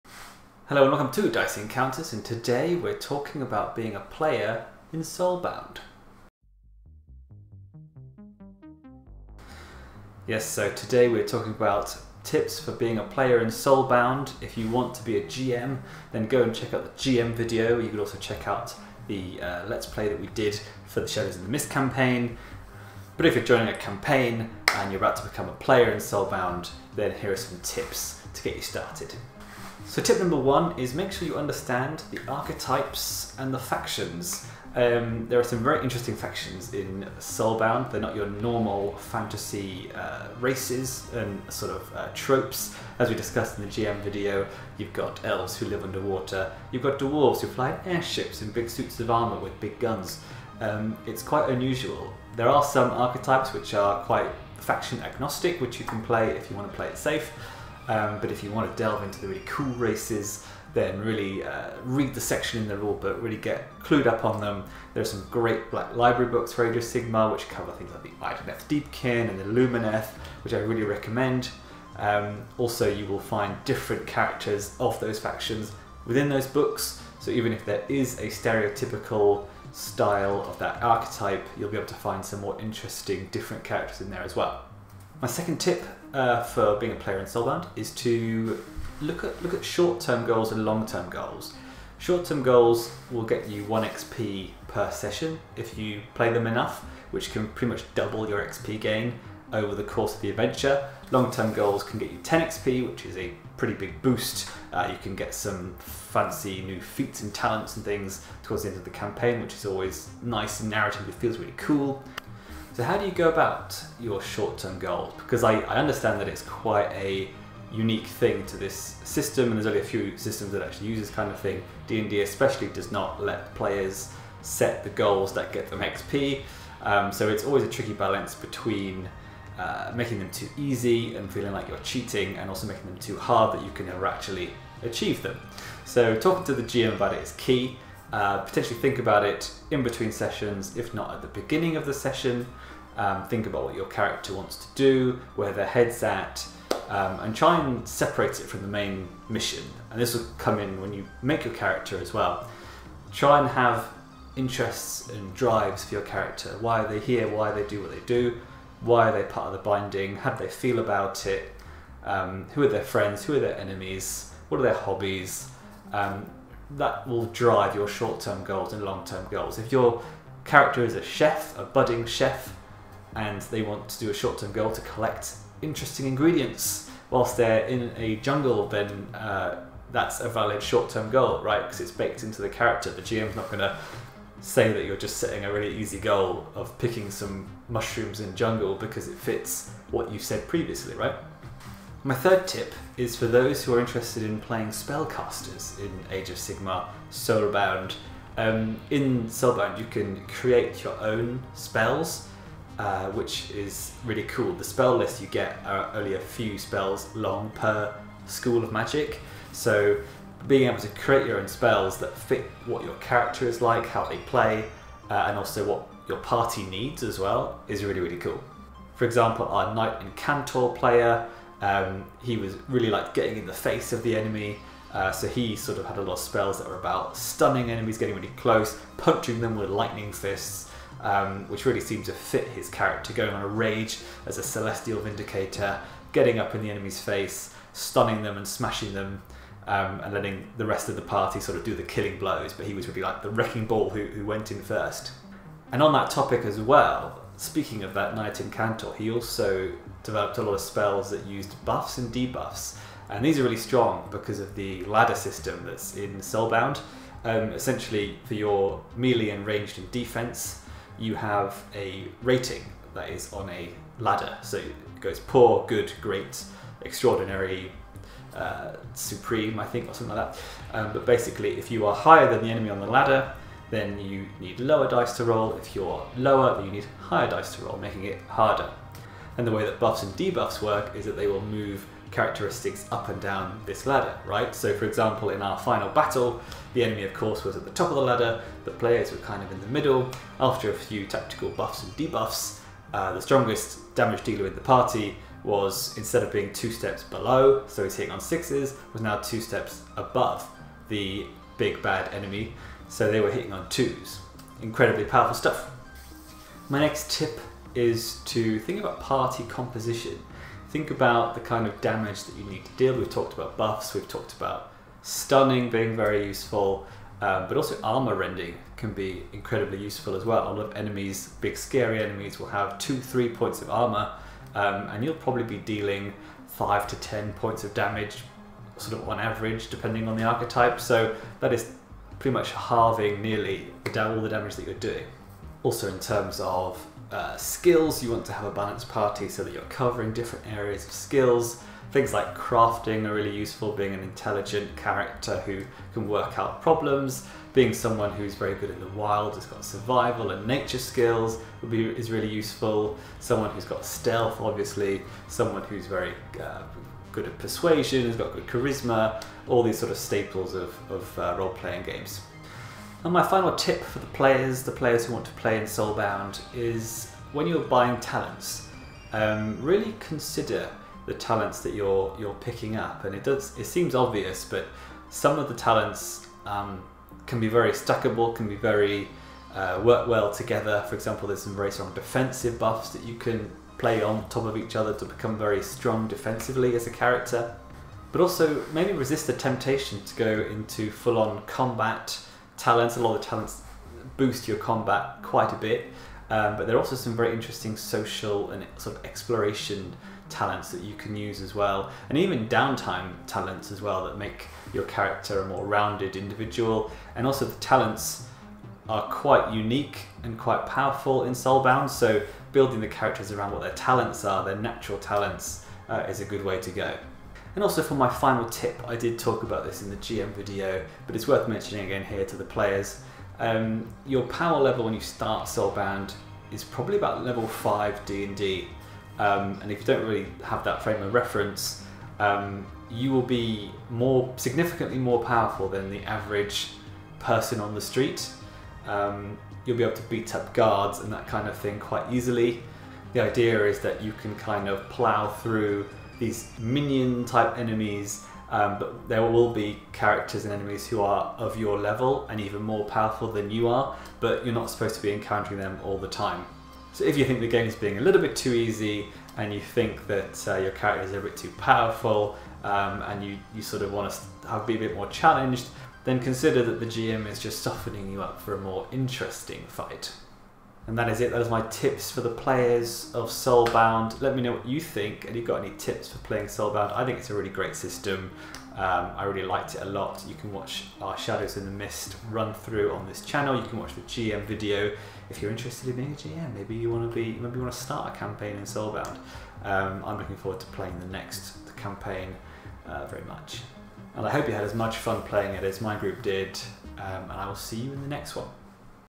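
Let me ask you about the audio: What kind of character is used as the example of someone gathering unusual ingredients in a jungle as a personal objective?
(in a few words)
a budding chef.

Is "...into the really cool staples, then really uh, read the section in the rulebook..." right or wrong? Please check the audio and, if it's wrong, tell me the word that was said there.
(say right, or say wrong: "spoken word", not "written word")
wrong: "races", not "staples".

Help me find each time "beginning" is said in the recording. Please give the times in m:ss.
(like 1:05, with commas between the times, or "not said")
2:21.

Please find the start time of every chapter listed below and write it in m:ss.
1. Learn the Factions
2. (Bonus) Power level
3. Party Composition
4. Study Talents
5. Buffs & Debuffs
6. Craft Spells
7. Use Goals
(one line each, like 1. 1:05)
1. 0:30
2. 6:57
3. 5:06
4. 6:02
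5. 4:05
6. 3:11
7. 1:25.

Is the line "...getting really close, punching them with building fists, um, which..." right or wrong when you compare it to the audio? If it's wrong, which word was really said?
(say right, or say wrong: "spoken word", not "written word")
wrong: "lightning", not "building".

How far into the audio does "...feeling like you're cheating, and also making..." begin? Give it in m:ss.
2:11.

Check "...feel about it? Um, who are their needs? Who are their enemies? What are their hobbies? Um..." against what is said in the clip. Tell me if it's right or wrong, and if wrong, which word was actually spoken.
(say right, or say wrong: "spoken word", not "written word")
wrong: "friends", not "needs".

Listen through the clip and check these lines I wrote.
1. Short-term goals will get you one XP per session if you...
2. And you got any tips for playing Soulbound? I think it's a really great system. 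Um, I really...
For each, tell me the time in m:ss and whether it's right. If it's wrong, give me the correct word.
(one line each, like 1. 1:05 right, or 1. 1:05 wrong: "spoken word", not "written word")
1. 1:31 right
2. 7:55 right.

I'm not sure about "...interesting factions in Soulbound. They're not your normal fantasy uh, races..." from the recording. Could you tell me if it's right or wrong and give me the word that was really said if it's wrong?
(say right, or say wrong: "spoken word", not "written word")
right.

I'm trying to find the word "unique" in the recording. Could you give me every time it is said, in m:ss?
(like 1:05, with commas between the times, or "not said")
1:57, 6:49.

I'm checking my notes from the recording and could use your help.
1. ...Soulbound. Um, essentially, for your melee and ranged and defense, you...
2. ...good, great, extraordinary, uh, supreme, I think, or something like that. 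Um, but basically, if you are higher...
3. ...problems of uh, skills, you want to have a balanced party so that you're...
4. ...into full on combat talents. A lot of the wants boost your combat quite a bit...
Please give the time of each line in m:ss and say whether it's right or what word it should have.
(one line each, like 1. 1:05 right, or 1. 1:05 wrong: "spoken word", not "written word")
1. 4:16 right
2. 4:25 right
3. 5:35 wrong: "terms", not "problems"
4. 6:30 wrong: "talents", not "wants".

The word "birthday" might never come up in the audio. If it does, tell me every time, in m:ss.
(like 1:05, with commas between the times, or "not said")
not said.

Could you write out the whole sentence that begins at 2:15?
So talking to the GM about it is key.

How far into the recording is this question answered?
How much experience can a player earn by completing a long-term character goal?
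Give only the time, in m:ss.
1:42.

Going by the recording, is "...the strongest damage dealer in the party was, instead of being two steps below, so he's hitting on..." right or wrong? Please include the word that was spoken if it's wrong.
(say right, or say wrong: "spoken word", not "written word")
right.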